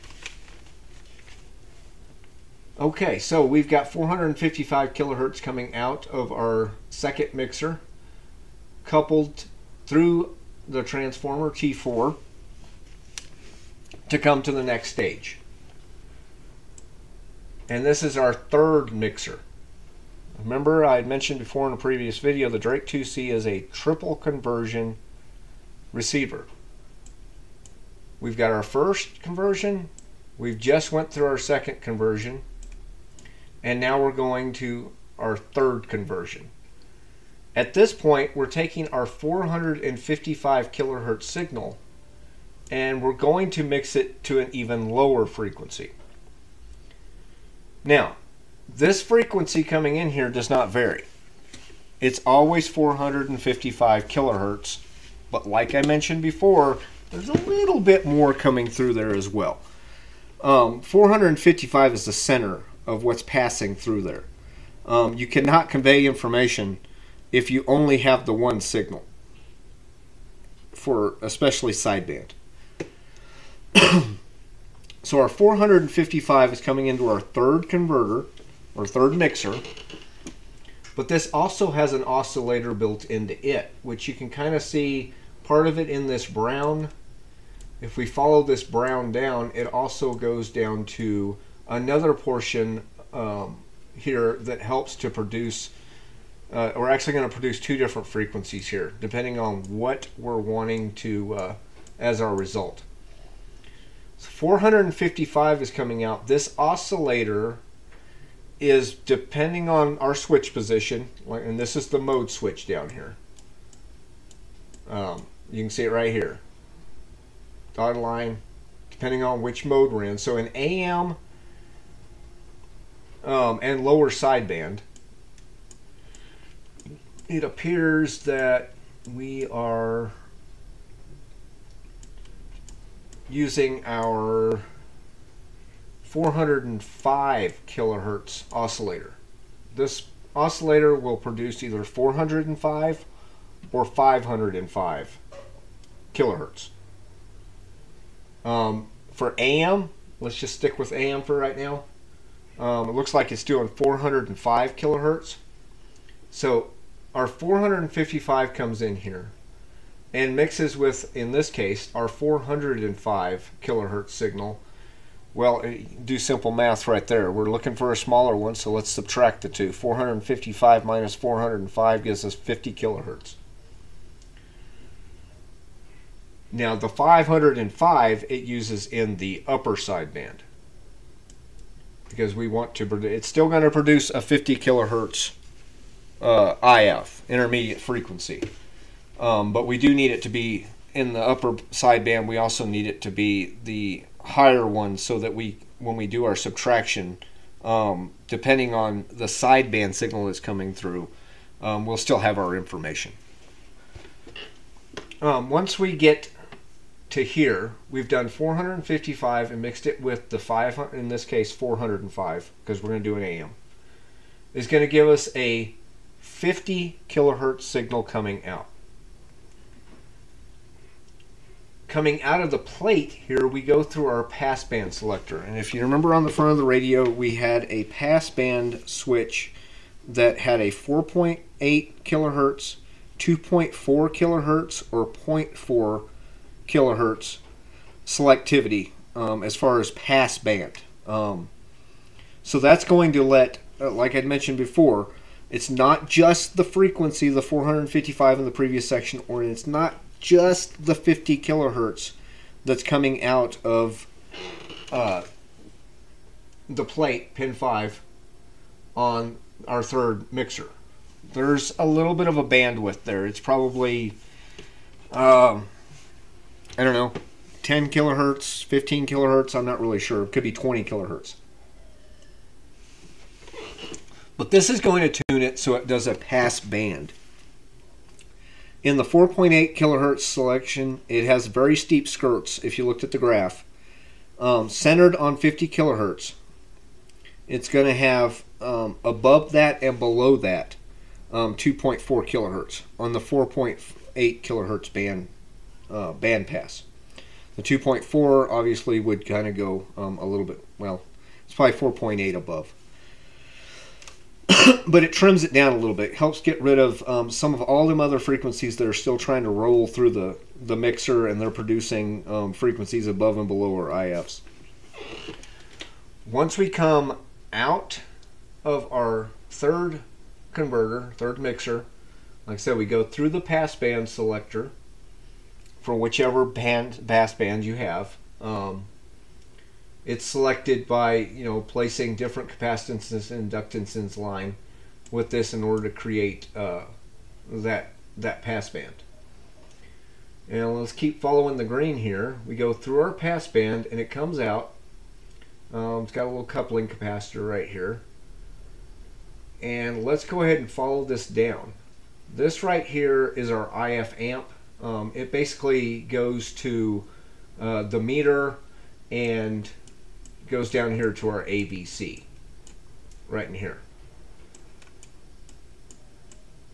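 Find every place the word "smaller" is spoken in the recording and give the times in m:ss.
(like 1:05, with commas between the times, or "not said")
2:47.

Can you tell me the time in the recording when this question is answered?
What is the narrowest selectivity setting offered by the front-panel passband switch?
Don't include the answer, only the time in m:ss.
3:55.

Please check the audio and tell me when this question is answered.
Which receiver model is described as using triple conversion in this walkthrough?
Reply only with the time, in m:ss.
0:22.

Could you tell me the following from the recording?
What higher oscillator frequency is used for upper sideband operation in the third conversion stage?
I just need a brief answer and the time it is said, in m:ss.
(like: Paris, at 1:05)
505 kHz, at 2:23.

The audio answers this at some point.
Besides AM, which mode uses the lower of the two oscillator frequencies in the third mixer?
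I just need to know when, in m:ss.
2:03.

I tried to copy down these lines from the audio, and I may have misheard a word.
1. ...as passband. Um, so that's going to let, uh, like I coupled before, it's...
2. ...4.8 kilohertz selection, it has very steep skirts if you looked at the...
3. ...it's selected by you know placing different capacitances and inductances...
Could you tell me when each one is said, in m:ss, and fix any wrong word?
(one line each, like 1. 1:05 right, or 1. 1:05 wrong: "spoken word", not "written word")
1. 3:59 wrong: "mentioned", not "coupled"
2. 4:39 right
3. 5:30 right.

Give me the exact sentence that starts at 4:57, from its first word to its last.
The 2.4 obviously would kind of go um, a little bit, well, it's probably 4.8 above.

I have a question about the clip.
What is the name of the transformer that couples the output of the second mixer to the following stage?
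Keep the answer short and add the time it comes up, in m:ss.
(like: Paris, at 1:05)
T4, at 0:11.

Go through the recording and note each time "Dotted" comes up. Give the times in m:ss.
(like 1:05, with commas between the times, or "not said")
1:57.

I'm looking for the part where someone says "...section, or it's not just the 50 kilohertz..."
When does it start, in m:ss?
4:08.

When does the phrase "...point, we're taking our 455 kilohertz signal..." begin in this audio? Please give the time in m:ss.
0:37.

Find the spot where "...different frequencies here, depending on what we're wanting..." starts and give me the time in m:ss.
1:37.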